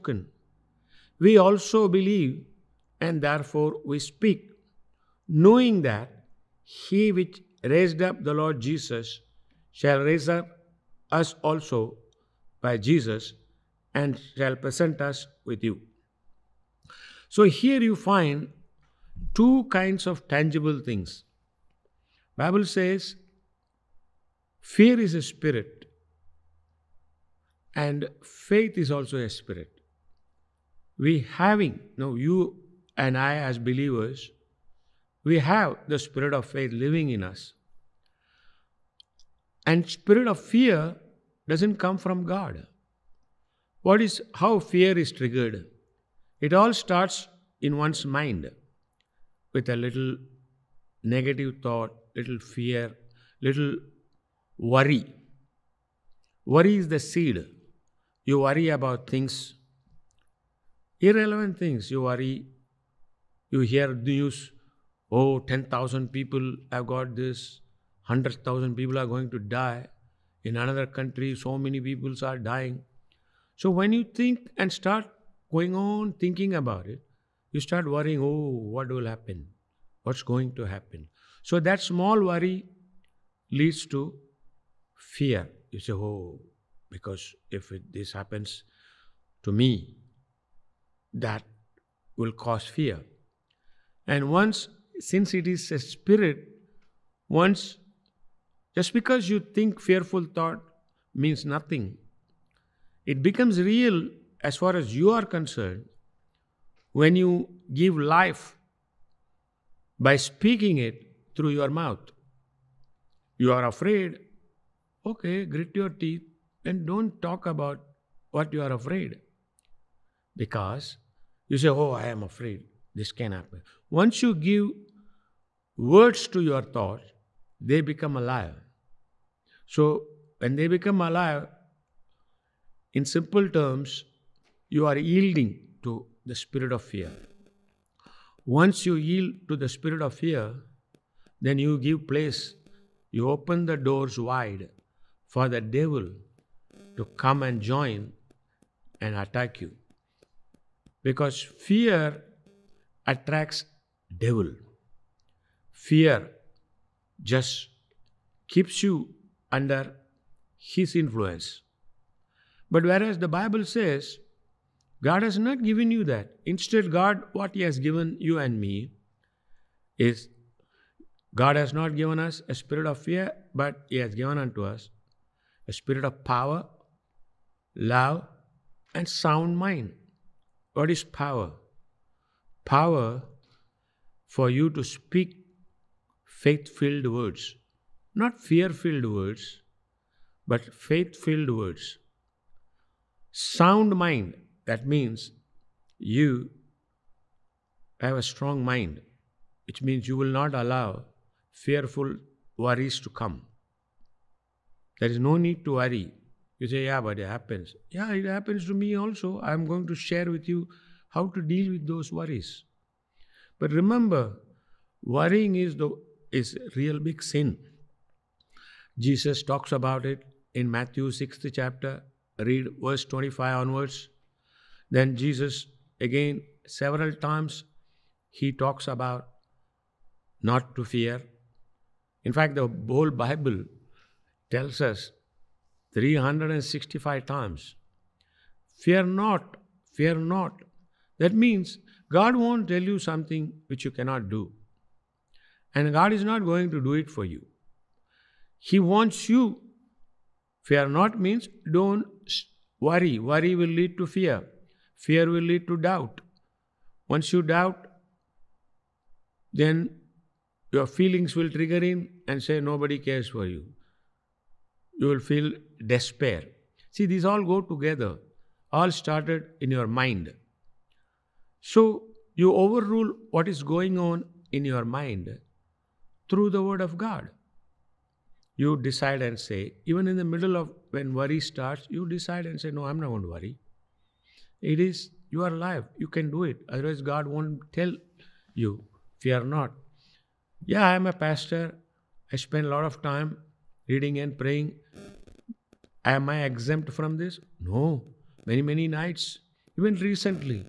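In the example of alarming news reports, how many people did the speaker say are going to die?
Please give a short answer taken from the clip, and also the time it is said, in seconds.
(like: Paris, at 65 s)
100,000, at 68 s.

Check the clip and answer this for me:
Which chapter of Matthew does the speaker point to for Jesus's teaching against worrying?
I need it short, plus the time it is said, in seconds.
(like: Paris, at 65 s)
6th chapter, at 221 s.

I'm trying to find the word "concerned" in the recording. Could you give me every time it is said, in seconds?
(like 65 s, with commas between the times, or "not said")
105 s.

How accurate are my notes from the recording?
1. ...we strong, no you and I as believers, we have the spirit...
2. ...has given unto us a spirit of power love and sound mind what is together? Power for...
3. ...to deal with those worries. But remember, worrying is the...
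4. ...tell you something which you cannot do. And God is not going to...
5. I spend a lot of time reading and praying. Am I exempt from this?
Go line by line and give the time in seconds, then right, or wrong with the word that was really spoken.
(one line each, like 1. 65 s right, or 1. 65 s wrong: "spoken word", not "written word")
1. 30 s wrong: "having", not "strong"
2. 173 s wrong: "power", not "together"
3. 211 s right
4. 242 s right
5. 292 s right.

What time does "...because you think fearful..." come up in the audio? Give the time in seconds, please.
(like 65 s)
98 s.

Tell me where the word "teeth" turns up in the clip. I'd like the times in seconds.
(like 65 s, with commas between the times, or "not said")
115 s.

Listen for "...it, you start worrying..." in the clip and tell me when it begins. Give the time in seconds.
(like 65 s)
76 s.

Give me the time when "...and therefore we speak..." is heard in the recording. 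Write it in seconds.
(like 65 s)
3 s.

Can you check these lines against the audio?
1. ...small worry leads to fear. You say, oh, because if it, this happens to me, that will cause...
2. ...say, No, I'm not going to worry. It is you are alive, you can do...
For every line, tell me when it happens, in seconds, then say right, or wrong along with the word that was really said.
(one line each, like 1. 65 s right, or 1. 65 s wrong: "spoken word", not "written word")
1. 81 s right
2. 282 s right.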